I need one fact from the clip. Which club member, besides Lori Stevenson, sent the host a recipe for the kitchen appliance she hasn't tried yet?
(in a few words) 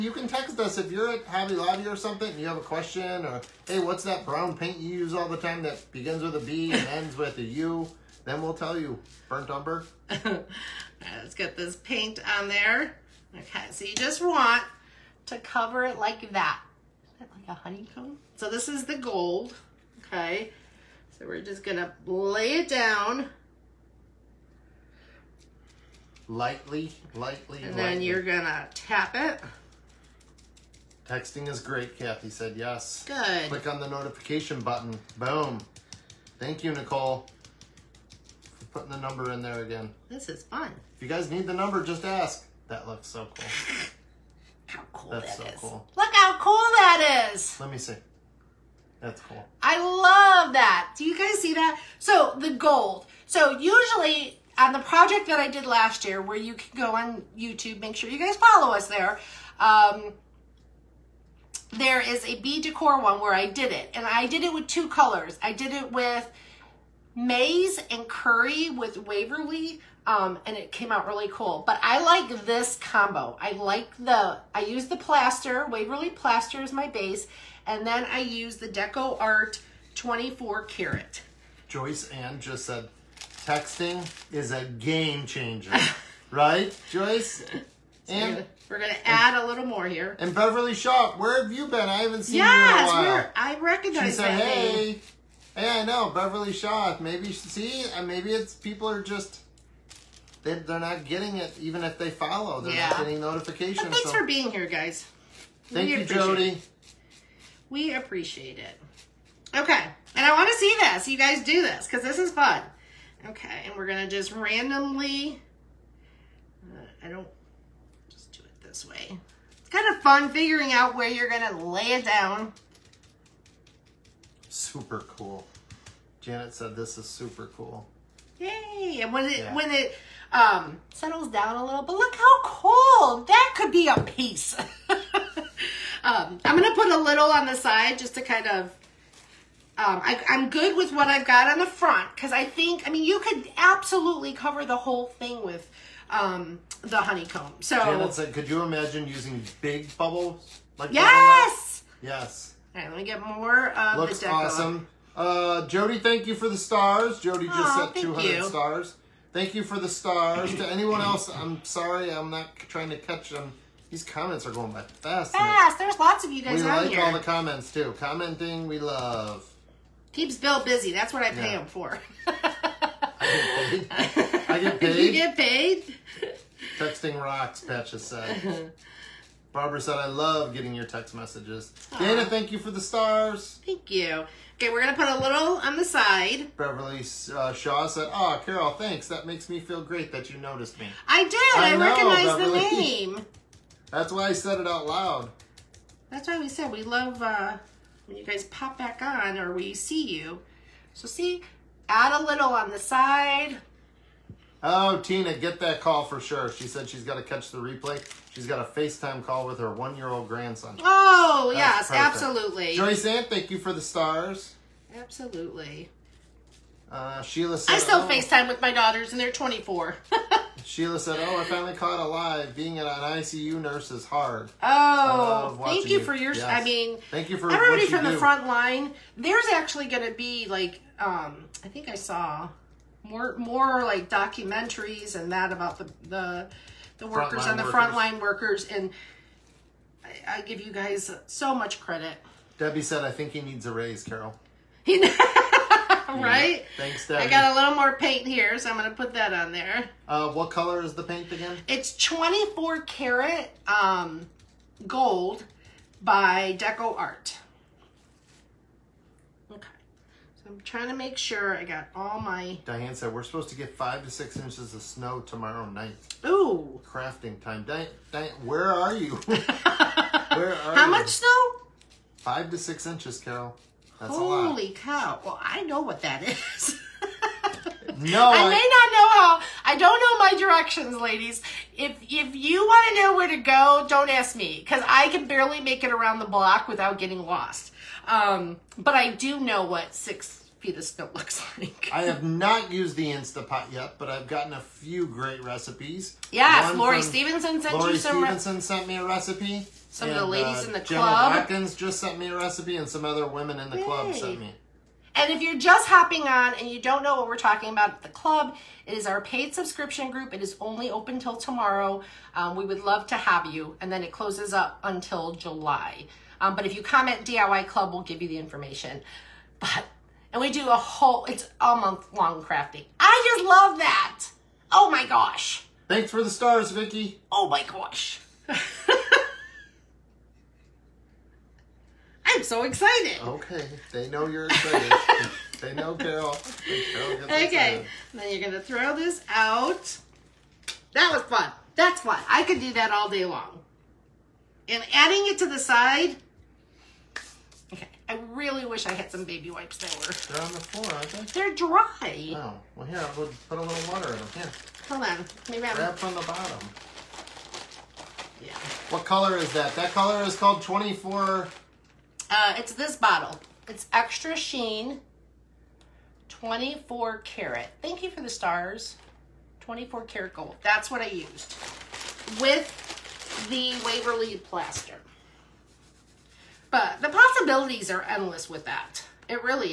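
Gemma Watkins.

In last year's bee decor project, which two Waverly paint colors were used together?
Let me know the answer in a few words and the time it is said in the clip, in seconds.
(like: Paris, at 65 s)
maize and curry, at 67 s.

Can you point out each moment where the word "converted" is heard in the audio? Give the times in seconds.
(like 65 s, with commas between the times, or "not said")
not said.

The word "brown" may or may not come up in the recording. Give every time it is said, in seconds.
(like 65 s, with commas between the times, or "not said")
4 s.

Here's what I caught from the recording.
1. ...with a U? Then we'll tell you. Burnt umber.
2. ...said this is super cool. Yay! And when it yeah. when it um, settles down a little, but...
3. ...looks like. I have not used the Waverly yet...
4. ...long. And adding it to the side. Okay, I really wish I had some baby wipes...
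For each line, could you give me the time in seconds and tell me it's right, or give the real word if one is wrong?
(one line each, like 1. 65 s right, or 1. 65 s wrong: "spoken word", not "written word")
1. 7 s right
2. 126 s right
3. 291 s wrong: "Instapot", not "Waverly"
4. 343 s right.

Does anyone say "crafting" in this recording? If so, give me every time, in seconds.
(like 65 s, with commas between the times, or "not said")
266 s, 322 s.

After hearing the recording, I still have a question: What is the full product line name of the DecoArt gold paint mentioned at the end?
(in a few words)
Extreme Sheen.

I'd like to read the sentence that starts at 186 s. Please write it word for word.
Beverly uh, Shaw said, Oh, Carol, thanks.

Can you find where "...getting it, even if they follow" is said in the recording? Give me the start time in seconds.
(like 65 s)
101 s.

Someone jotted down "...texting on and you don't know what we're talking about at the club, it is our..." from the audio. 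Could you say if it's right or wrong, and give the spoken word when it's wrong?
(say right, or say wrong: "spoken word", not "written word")
wrong: "hopping", not "texting".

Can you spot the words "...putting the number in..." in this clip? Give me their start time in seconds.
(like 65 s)
38 s.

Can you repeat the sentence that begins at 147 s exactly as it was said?
So, Janet said, could you imagine using big bubbles?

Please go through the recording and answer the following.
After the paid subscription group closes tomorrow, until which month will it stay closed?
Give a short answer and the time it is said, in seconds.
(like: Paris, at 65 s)
July, at 315 s.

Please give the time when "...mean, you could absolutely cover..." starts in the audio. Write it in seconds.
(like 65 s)
142 s.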